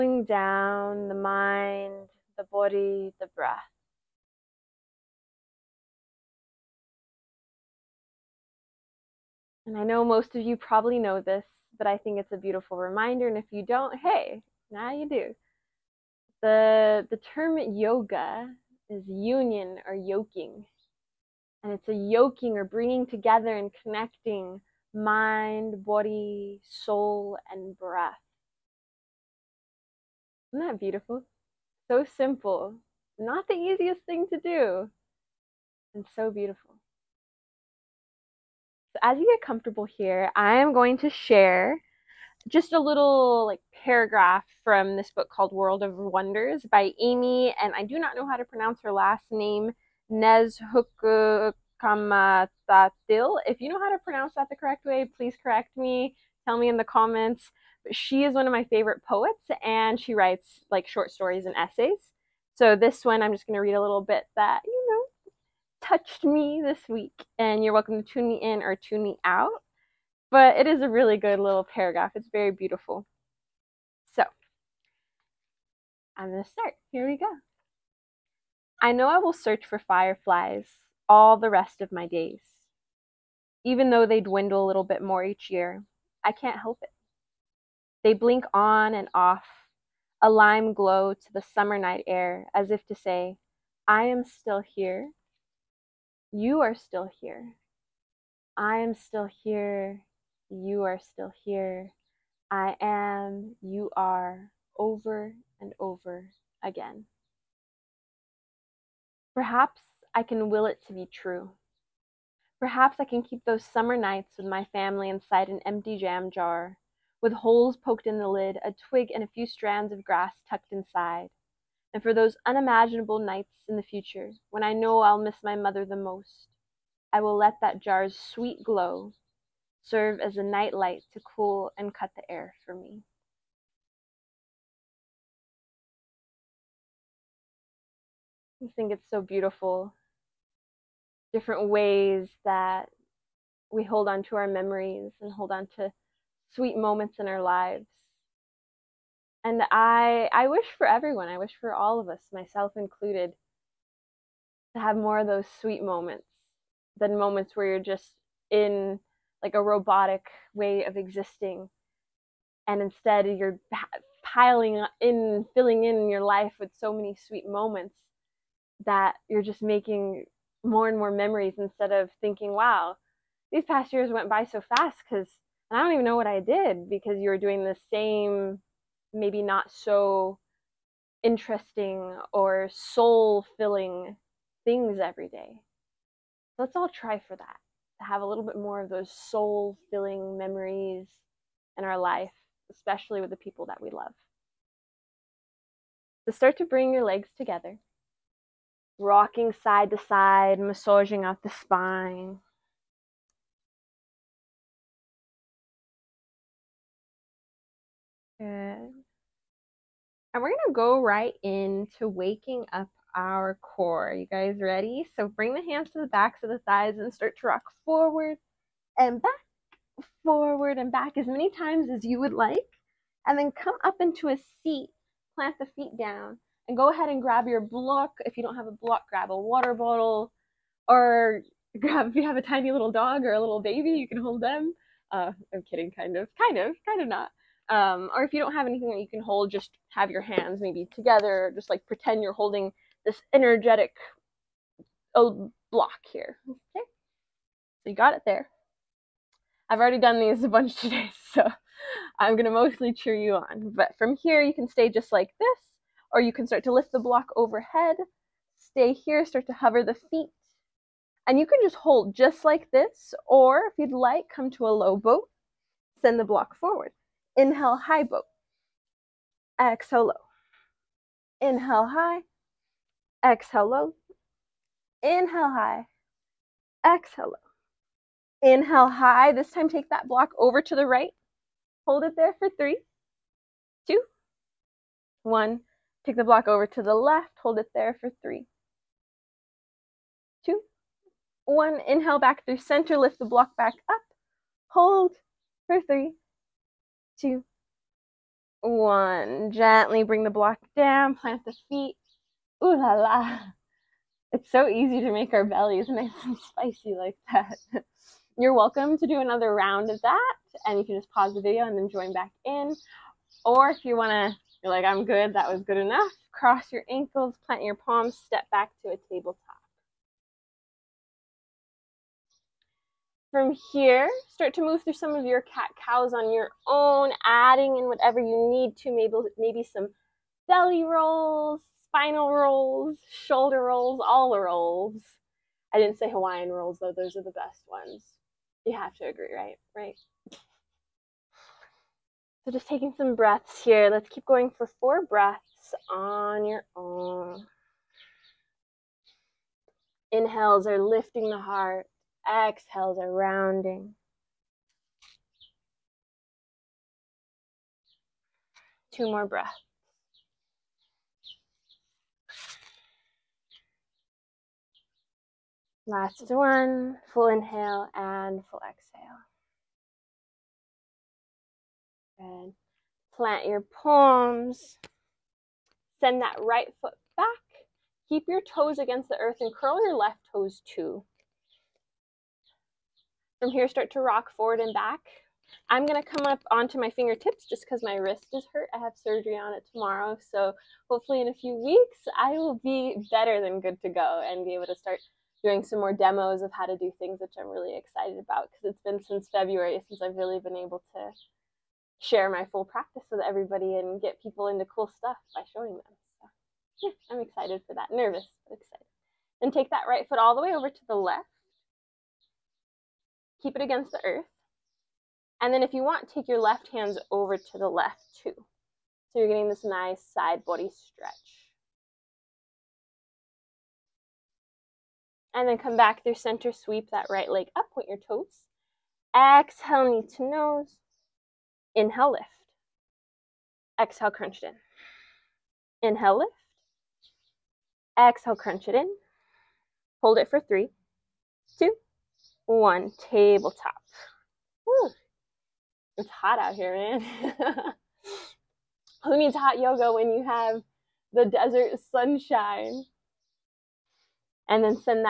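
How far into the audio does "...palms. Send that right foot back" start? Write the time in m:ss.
6:13.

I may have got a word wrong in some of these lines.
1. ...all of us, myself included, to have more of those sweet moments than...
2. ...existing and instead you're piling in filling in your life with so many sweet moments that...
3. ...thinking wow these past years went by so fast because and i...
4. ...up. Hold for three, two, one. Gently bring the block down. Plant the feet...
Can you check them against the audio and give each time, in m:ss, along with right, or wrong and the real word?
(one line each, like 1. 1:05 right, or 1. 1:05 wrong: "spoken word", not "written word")
1. 2:31 right
2. 2:40 right
3. 2:52 right
4. 4:53 right.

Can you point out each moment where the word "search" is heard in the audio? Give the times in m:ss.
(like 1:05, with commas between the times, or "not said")
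1:19.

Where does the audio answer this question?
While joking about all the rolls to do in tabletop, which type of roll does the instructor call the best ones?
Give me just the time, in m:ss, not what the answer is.
5:36.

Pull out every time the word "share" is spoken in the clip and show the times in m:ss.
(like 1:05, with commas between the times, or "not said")
0:41, 6:41.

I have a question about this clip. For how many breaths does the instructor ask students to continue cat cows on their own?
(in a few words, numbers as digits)
4.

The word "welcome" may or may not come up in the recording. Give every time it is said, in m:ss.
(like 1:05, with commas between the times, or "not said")
1:07, 5:08.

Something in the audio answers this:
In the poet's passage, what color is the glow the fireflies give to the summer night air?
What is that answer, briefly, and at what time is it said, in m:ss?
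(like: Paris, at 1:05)
lime, at 1:30.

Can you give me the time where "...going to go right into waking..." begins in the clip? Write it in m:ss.
3:30.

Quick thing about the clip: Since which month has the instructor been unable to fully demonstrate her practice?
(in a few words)
February.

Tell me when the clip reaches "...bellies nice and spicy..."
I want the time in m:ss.
5:05.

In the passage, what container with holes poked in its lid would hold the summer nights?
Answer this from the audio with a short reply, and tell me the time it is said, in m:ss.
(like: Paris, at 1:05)
empty jam jar, at 1:55.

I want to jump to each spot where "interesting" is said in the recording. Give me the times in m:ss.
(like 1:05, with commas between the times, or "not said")
3:01.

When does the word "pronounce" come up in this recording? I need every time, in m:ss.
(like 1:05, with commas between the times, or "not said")
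0:48, 0:54.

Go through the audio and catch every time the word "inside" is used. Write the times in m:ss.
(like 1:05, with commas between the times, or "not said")
1:55, 2:00.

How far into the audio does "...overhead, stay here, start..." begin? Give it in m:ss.
4:17.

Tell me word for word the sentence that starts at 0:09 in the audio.
And I know most of you probably know this, but I think it's a beautiful reminder.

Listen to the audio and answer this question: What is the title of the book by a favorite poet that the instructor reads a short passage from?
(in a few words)
World of Wonders.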